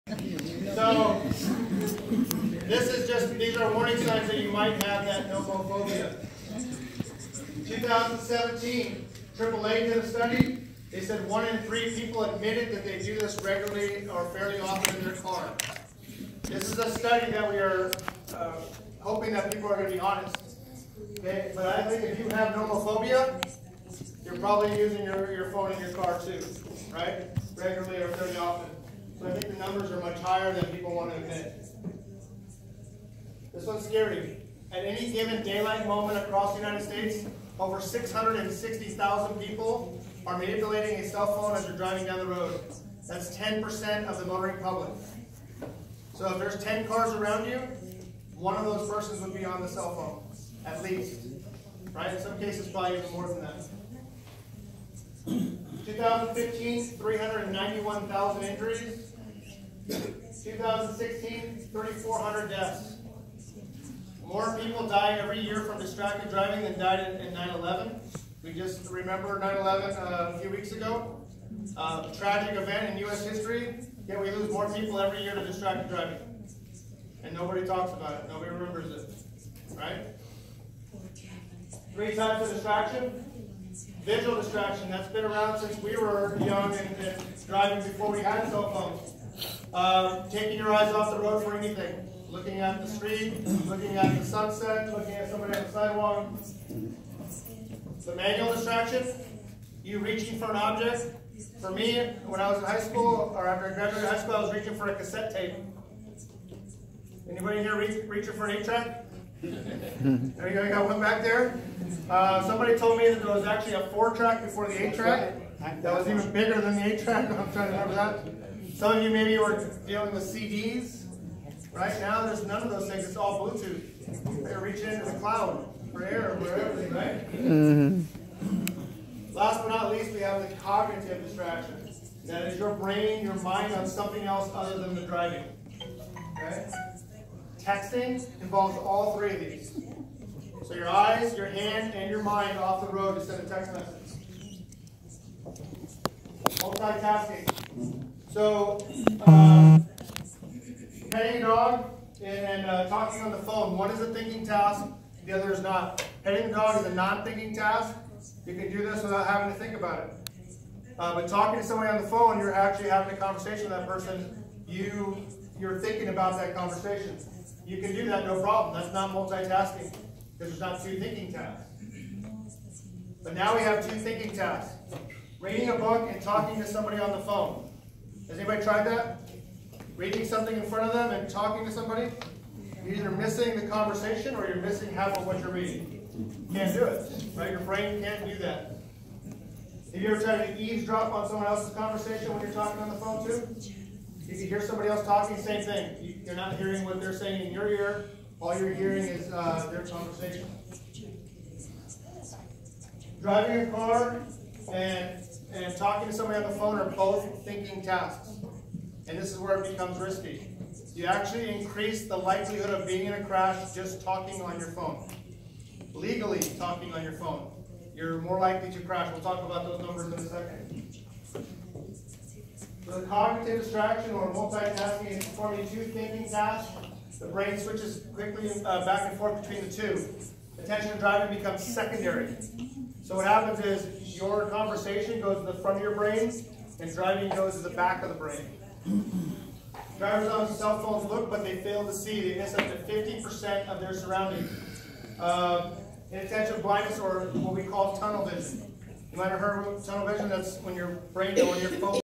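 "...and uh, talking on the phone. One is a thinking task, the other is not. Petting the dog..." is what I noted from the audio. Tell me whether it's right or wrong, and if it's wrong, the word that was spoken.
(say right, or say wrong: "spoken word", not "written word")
right.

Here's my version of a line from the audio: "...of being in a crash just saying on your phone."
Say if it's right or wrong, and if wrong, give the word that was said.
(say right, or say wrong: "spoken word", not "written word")
wrong: "talking", not "saying".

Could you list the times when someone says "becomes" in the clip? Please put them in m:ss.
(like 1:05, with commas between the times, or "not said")
3:29, 3:51.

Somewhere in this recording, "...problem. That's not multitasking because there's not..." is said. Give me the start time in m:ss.
2:48.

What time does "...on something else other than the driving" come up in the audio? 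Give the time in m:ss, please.
2:13.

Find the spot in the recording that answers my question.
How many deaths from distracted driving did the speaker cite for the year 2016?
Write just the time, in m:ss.
1:01.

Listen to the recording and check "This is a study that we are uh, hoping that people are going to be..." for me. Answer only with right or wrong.
right.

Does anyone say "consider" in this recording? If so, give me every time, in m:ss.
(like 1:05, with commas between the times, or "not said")
not said.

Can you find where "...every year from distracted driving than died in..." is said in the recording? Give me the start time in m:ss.
1:05.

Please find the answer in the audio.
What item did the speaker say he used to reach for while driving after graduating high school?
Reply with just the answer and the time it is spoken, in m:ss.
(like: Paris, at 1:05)
A cassette tape, at 1:44.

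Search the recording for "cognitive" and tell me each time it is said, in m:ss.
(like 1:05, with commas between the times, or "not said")
2:10, 3:43.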